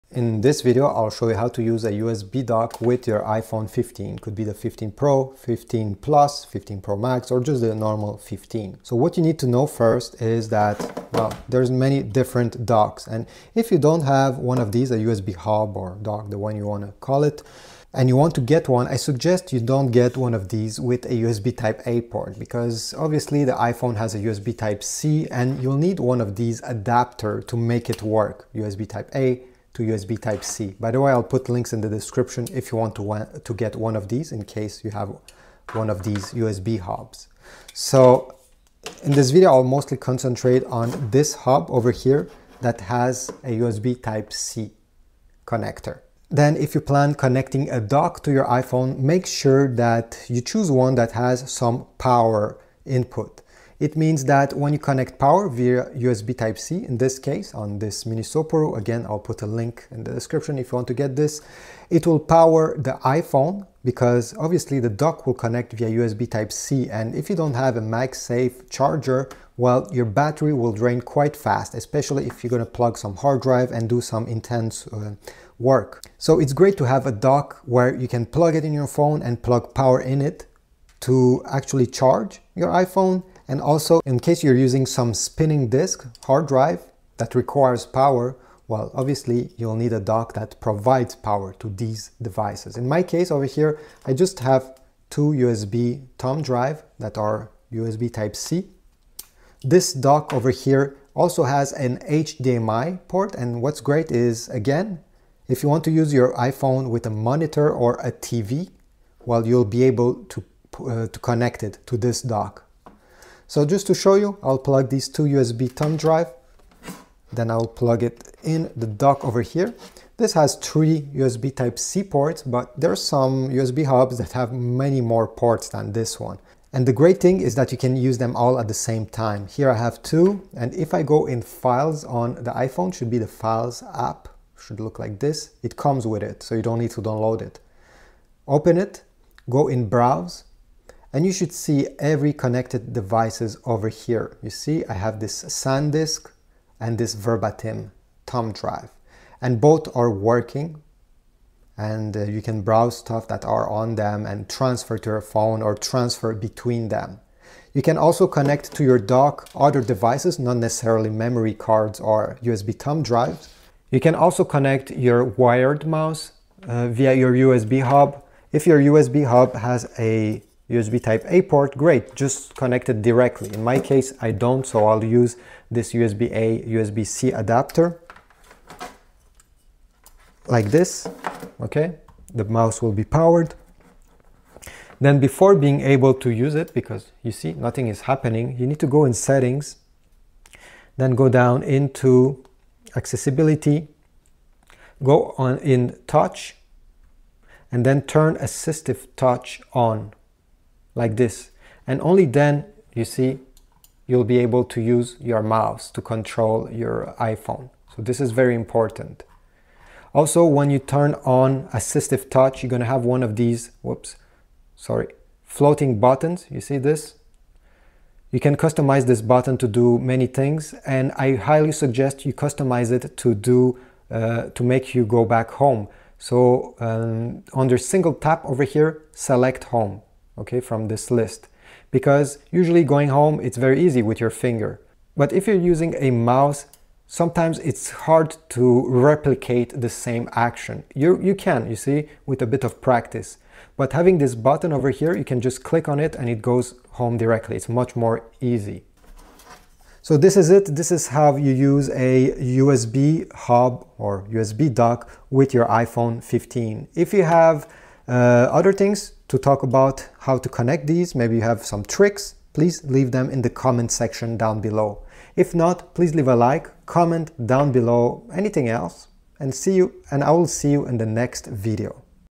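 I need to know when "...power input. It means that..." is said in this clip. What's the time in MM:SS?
00:51.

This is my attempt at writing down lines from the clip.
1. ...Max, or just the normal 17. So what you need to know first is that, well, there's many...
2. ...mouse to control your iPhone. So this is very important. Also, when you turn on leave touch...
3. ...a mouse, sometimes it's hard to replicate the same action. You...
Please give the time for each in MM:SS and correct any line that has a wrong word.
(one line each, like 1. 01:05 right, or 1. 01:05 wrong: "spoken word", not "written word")
1. 00:06 wrong: "15", not "17"
2. 03:25 wrong: "assistive", not "leave"
3. 03:55 right.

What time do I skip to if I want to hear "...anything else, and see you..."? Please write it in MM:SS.
04:28.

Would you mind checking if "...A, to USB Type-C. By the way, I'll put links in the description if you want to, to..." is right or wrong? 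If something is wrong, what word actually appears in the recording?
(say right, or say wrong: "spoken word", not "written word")
right.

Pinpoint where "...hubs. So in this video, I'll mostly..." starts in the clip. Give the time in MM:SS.
00:36.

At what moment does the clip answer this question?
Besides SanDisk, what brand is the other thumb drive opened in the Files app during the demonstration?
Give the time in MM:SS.
02:27.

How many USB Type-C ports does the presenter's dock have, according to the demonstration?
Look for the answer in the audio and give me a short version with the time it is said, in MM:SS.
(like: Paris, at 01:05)
3, at 02:00.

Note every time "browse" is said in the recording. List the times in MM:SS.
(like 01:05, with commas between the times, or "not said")
02:19, 02:32.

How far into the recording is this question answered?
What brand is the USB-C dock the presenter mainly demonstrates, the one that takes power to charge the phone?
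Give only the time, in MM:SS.
00:58.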